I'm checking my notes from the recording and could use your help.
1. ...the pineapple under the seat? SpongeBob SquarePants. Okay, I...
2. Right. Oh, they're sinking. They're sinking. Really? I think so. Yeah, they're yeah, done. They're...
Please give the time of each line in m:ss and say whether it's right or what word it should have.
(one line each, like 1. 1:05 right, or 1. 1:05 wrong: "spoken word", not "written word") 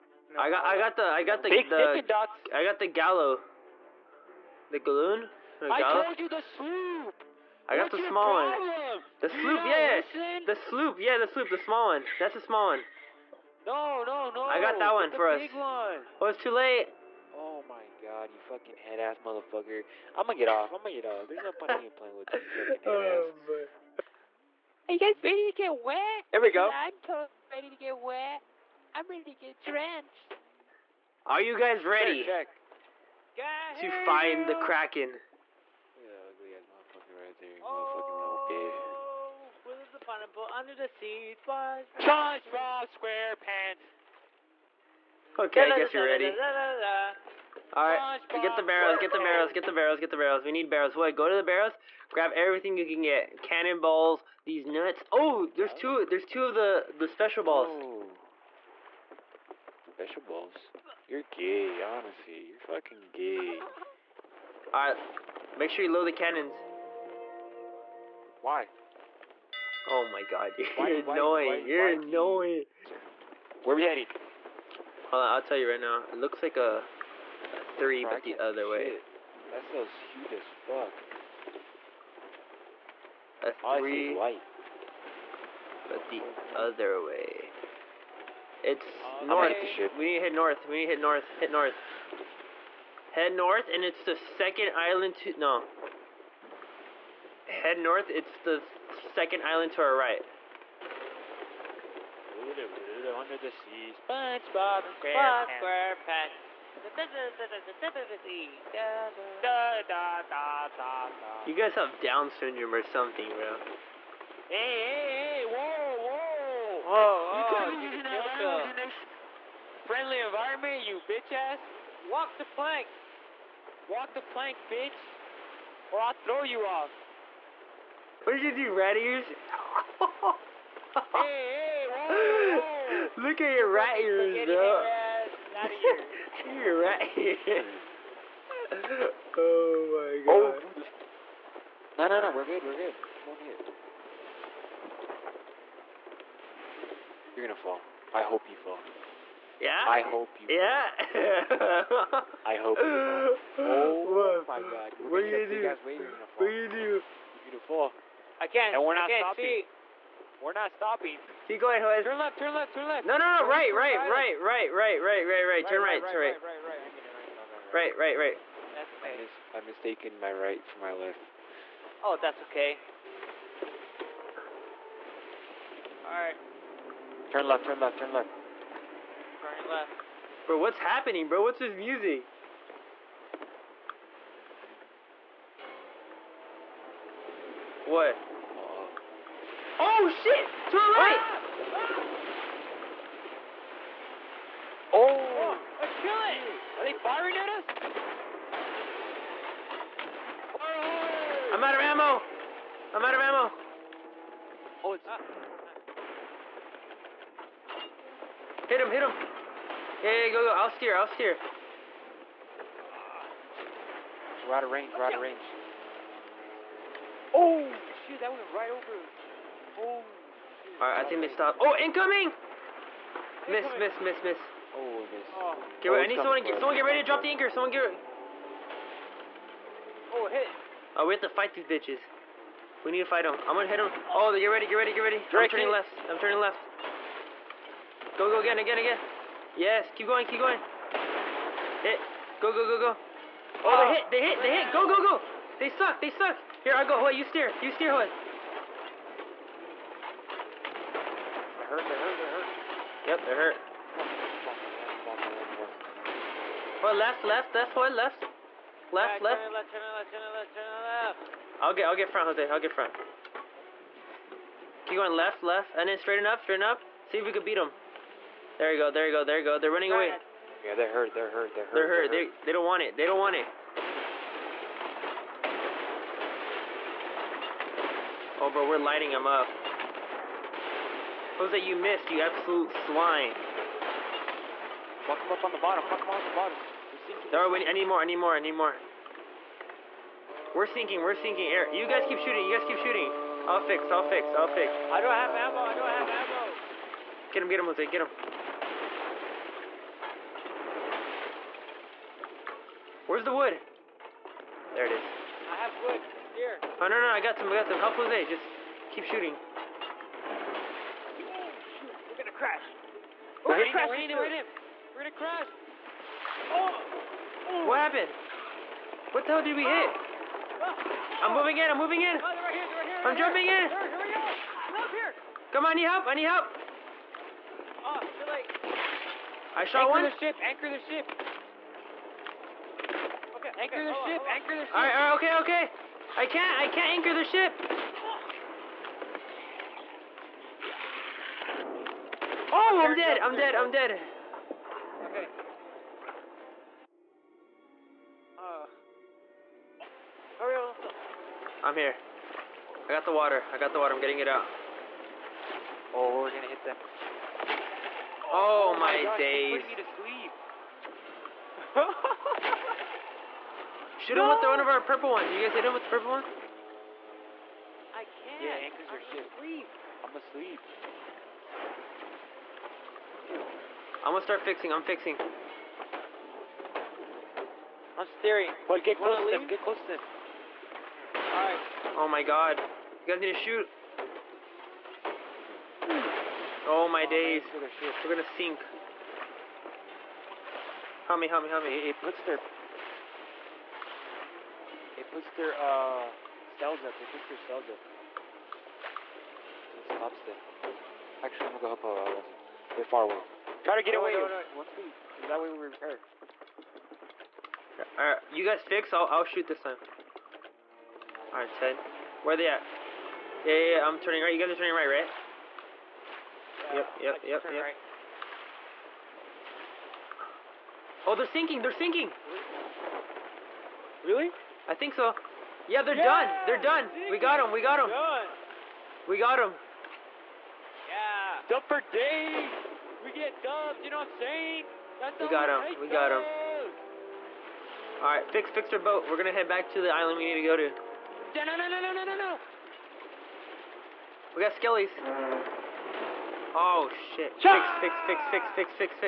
1. 0:39 right
2. 6:57 right.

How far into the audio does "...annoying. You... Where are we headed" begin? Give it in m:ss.
1:11.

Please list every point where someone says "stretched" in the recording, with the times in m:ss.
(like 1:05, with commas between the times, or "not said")
not said.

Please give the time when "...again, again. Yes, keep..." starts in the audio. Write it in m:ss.
3:58.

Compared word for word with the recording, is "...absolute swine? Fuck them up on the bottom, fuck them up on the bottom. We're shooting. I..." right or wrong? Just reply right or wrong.
wrong.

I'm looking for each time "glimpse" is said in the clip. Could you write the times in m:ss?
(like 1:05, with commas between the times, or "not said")
not said.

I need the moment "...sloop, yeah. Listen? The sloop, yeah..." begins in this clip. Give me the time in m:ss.
0:09.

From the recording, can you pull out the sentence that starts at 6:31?
It, it puts their it puts their uh, cells up.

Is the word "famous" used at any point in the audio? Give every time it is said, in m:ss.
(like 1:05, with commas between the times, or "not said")
not said.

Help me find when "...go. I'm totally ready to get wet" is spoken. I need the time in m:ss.
0:26.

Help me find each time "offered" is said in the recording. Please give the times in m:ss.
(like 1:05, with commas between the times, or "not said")
not said.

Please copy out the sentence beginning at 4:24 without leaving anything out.
Keep going left, left, and then straighten up, straighten up.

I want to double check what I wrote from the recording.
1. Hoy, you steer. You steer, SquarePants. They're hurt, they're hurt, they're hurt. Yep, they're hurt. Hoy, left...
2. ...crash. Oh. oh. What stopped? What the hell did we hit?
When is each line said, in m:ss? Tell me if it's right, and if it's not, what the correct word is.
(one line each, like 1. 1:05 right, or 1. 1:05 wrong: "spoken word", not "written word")
1. 4:06 wrong: "Hoy", not "SquarePants"
2. 5:15 wrong: "happened", not "stopped".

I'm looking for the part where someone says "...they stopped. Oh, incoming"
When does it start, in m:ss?
3:41.